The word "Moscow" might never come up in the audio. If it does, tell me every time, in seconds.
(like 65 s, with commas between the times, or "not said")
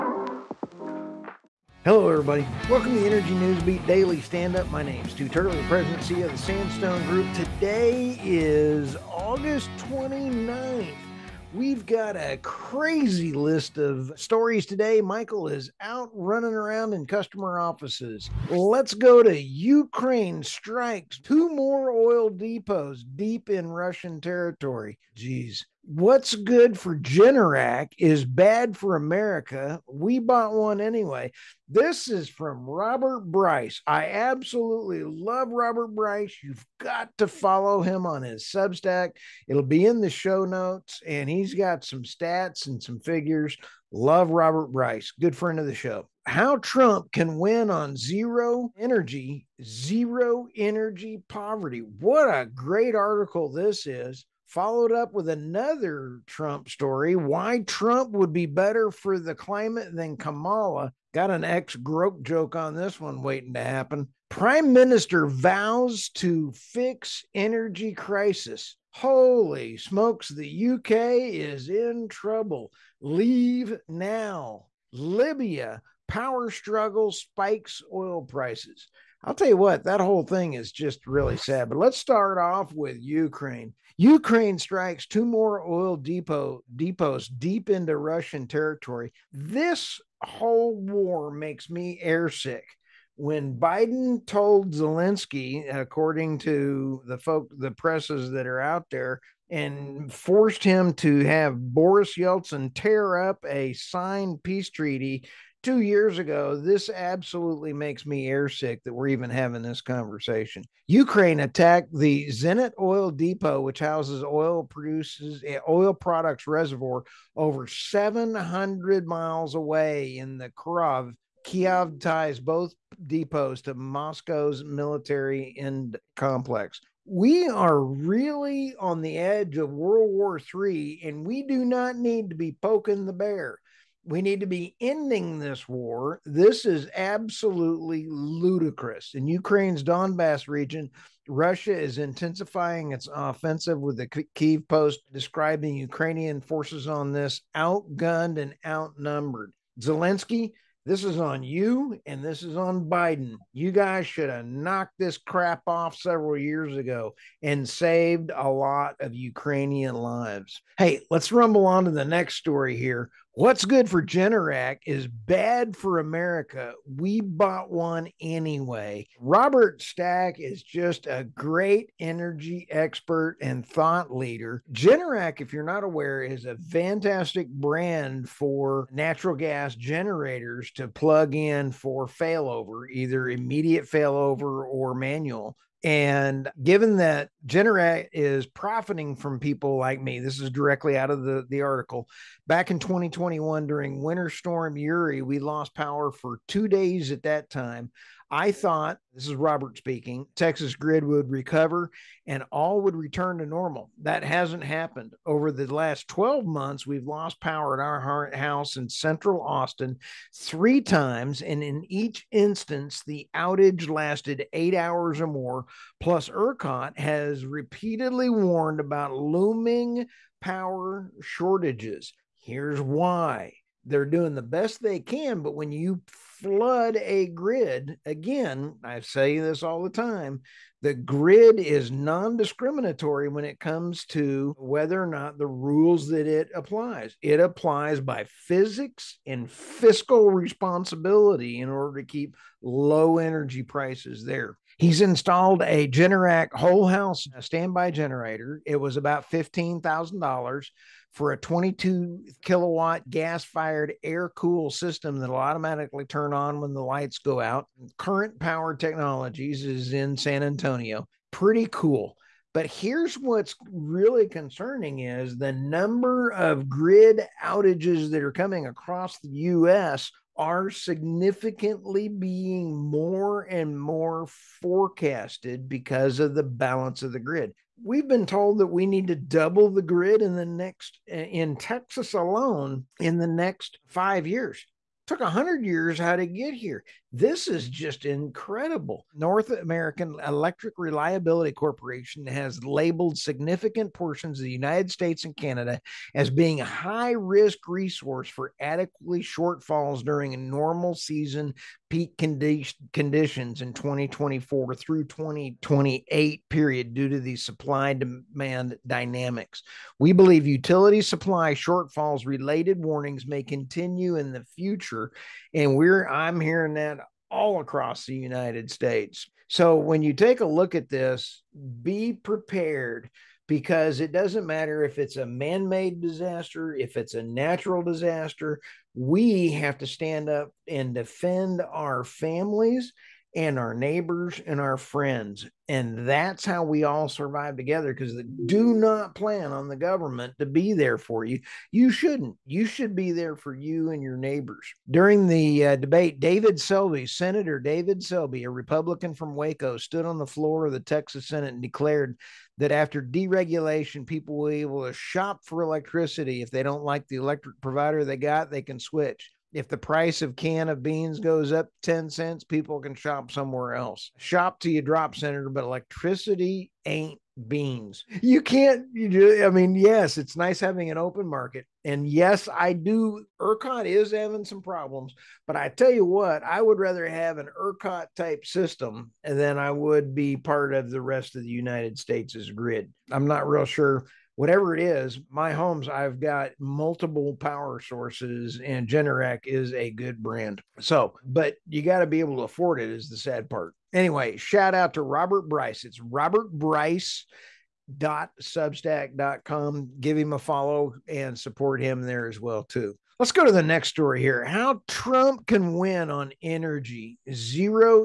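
123 s.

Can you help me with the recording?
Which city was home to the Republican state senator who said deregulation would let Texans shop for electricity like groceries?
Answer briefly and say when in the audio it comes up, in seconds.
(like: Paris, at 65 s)
Waco, at 349 s.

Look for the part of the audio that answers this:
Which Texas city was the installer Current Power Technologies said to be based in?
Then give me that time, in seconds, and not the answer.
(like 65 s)
260 s.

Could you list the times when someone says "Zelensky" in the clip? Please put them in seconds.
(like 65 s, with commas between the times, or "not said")
94 s, 149 s.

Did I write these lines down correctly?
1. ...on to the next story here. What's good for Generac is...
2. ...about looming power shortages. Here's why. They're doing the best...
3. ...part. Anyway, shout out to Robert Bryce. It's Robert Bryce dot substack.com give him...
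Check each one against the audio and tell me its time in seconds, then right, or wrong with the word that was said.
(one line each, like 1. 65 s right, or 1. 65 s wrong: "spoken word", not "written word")
1. 161 s right
2. 218 s right
3. 393 s right.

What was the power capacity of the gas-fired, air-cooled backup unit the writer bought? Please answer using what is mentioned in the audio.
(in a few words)
22 kilowatts.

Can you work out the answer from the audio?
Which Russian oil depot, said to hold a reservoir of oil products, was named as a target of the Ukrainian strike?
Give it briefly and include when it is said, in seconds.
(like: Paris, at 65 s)
Zenit, at 112 s.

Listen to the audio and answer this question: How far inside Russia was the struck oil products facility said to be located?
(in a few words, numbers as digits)
over 700 miles.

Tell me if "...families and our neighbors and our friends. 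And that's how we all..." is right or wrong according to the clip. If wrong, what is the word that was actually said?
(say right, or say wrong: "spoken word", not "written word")
right.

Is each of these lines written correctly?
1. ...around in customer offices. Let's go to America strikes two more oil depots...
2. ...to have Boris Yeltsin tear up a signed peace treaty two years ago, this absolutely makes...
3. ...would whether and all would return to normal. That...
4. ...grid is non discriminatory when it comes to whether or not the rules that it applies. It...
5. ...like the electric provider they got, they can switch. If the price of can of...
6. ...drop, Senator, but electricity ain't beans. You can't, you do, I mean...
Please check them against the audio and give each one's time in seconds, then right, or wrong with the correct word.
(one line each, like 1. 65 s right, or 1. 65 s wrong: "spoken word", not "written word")
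1. 16 s wrong: "Ukraine", not "America"
2. 100 s right
3. 201 s wrong: "recover", not "whether"
4. 230 s right
5. 356 s right
6. 364 s right.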